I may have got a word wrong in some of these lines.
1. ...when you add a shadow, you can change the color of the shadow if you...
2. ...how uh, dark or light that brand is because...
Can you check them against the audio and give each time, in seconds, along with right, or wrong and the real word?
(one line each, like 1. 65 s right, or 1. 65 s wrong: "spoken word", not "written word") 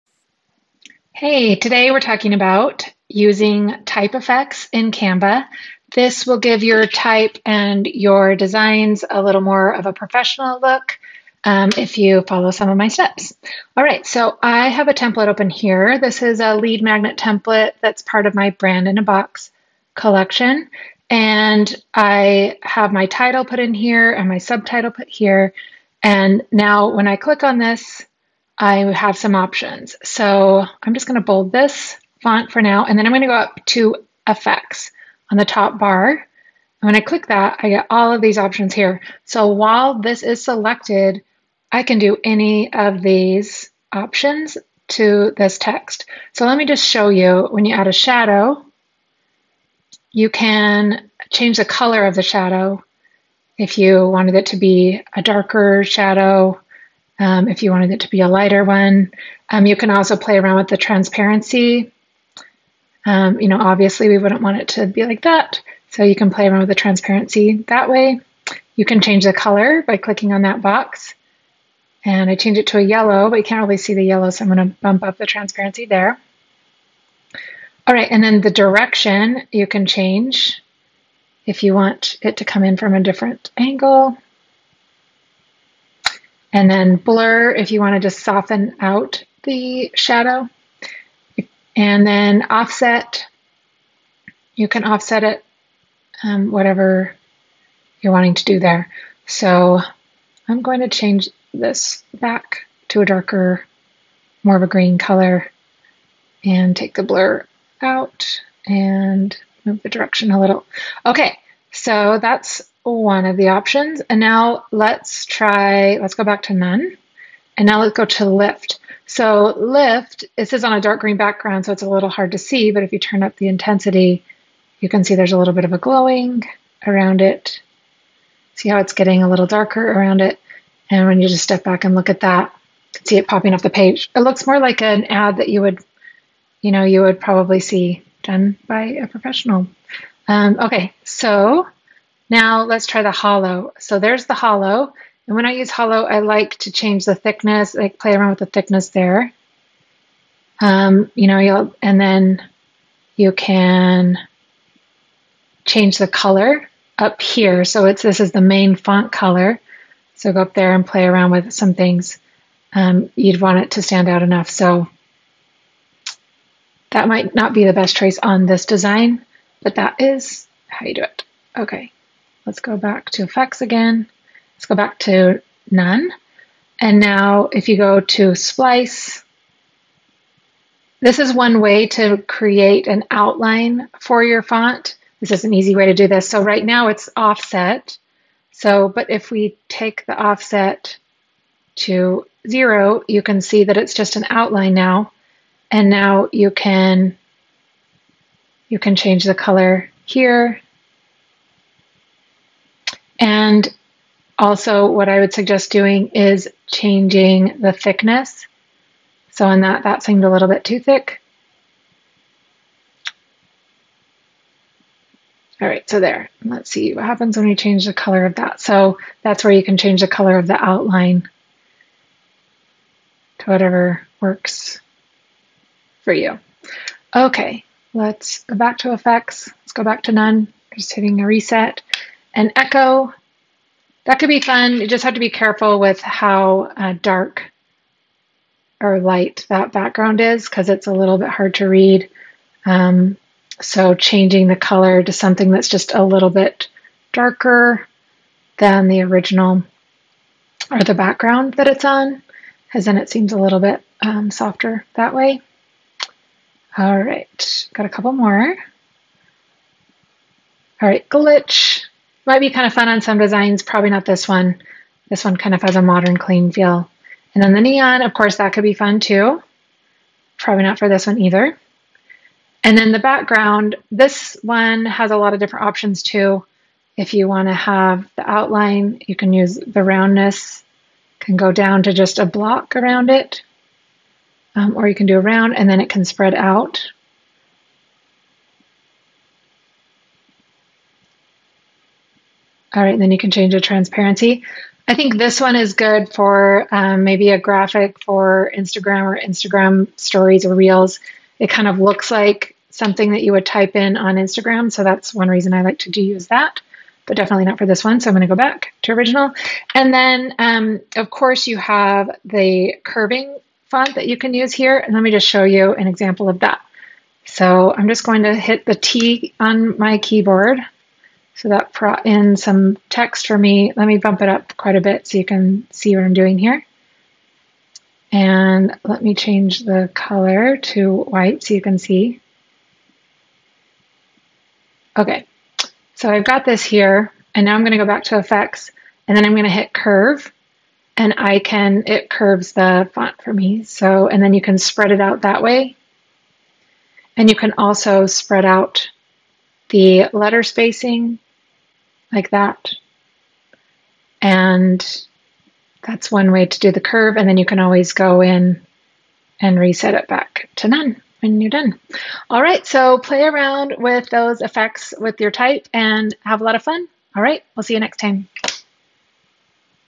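1. 47 s right
2. 236 s wrong: "background", not "brand".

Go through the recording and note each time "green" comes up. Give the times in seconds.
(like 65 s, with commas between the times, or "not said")
104 s, 121 s.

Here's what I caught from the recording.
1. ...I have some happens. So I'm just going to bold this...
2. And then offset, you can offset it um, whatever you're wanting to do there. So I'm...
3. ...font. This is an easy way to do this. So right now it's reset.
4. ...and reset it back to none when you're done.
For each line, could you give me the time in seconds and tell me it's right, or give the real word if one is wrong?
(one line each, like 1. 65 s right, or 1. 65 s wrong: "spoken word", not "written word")
1. 28 s wrong: "options", not "happens"
2. 91 s right
3. 184 s wrong: "offset", not "reset"
4. 359 s right.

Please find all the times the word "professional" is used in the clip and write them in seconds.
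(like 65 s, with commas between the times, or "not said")
9 s, 139 s.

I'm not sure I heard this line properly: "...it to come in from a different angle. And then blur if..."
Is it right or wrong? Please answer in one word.
right.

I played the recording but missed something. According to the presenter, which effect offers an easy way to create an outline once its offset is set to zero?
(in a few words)
splice.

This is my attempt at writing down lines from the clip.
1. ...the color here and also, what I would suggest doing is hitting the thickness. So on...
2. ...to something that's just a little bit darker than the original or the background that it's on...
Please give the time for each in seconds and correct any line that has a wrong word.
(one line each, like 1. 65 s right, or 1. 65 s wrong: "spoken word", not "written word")
1. 199 s wrong: "changing", not "hitting"
2. 245 s right.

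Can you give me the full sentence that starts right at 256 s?
All right, got a couple more.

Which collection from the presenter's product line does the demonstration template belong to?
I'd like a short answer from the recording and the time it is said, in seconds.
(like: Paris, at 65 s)
brand in a box, at 18 s.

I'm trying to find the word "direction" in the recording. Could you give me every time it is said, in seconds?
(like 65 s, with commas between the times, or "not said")
78 s, 109 s.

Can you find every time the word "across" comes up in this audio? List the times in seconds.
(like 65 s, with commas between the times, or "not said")
not said.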